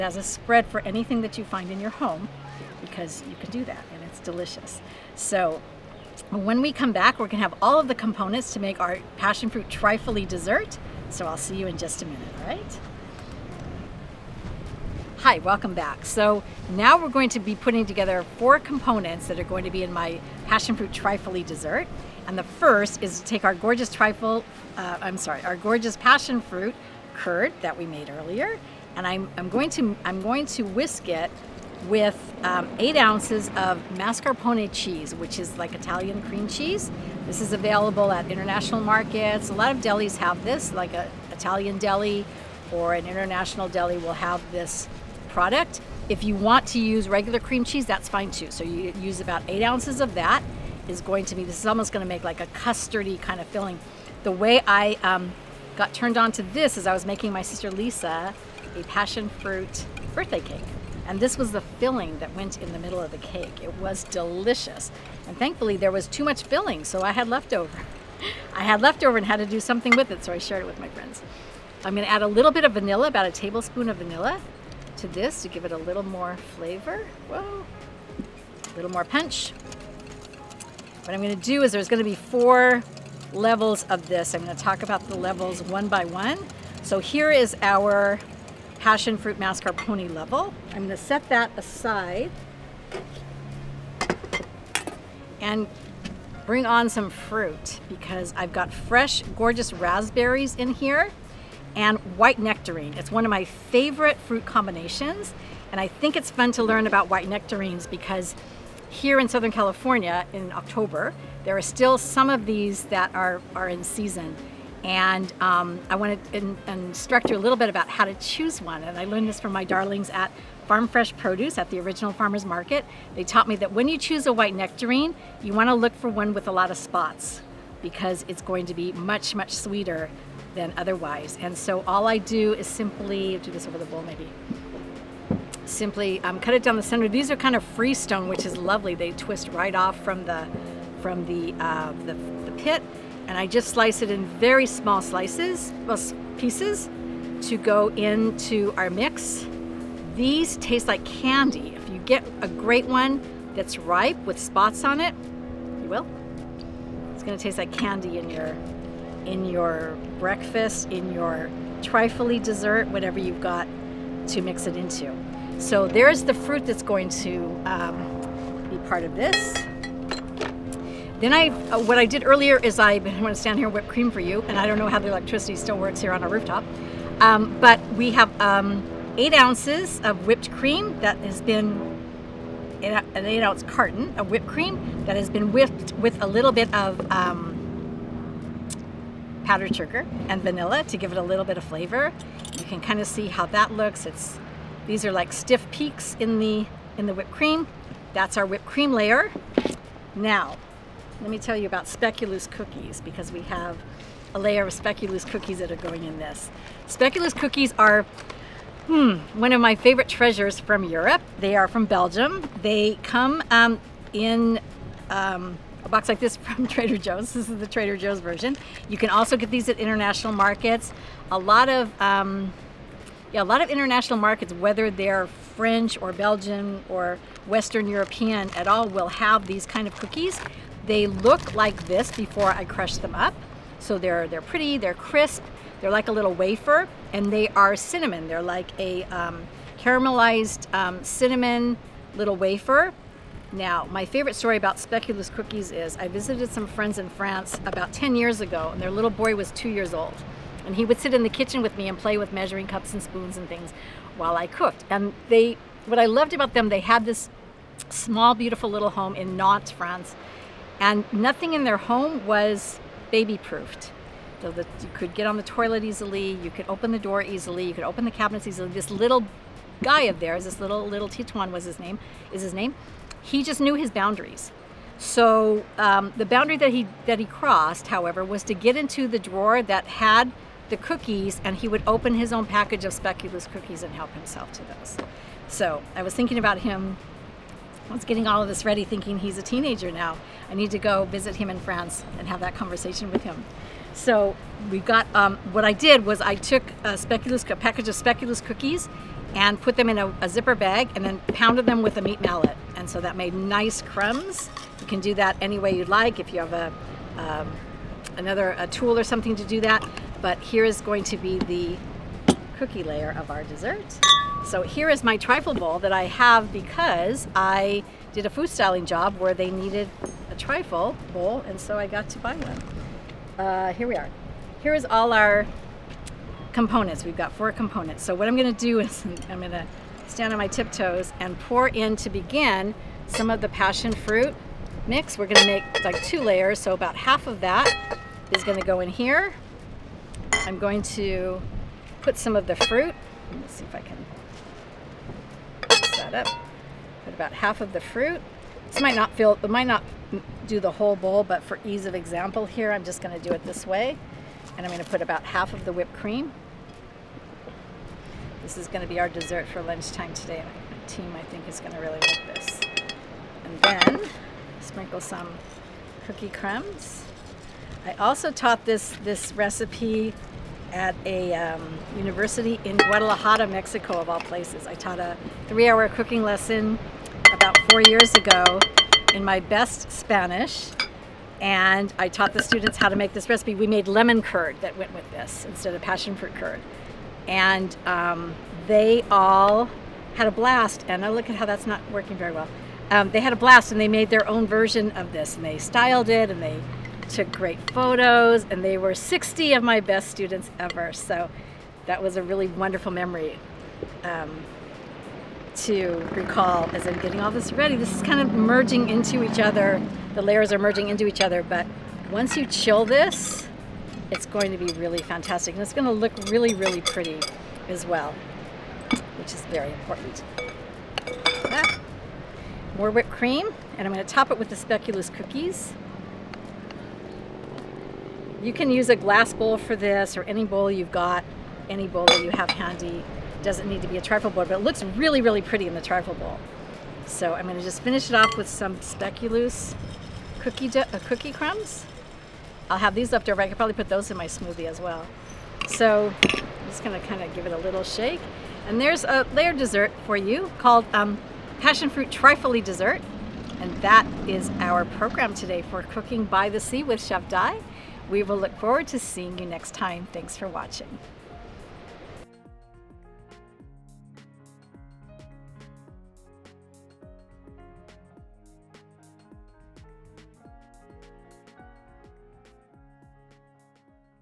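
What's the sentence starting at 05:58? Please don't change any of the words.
This is gonna be our dessert for lunchtime today.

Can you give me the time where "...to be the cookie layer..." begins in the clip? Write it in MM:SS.
05:11.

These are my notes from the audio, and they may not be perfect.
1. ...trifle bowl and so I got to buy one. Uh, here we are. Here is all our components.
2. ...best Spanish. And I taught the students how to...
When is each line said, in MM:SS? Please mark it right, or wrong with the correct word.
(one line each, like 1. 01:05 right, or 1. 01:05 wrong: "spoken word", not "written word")
1. 05:20 right
2. 06:19 right.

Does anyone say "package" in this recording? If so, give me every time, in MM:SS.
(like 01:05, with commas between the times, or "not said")
04:42, 04:57.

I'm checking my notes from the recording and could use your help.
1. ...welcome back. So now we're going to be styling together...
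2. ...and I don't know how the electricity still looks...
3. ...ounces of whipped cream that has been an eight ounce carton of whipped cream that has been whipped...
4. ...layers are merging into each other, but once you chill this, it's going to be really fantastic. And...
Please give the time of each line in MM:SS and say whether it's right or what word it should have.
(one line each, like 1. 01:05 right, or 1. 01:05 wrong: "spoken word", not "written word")
1. 00:15 wrong: "putting", not "styling"
2. 02:54 wrong: "works", not "looks"
3. 02:59 right
4. 06:50 right.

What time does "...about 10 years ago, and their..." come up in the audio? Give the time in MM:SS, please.
04:07.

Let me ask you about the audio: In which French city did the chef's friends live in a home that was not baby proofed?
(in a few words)
Nantes.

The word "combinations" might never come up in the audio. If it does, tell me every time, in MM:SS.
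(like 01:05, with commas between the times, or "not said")
01:44.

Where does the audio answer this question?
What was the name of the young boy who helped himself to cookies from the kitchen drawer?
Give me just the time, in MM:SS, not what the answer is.
04:31.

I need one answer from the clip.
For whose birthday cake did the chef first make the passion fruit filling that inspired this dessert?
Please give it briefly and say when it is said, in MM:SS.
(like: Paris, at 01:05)
Lisa, at 00:57.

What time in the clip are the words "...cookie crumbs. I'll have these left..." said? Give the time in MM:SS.
07:21.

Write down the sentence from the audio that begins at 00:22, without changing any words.
And the first is to take our gorgeous trifle, uh, I'm sorry, our gorgeous passion fruit curd that we made earlier.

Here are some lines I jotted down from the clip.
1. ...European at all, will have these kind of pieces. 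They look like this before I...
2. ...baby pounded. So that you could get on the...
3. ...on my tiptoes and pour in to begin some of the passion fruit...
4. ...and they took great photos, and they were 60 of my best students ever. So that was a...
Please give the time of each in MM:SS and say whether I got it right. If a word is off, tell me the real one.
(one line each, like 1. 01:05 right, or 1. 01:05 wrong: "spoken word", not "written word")
1. 03:47 wrong: "cookies", not "pieces"
2. 04:23 wrong: "proofed", not "pounded"
3. 05:30 right
4. 06:36 right.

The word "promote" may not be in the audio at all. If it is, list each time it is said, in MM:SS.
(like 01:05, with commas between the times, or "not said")
not said.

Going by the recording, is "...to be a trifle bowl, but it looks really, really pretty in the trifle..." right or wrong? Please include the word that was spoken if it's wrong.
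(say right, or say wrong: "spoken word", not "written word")
right.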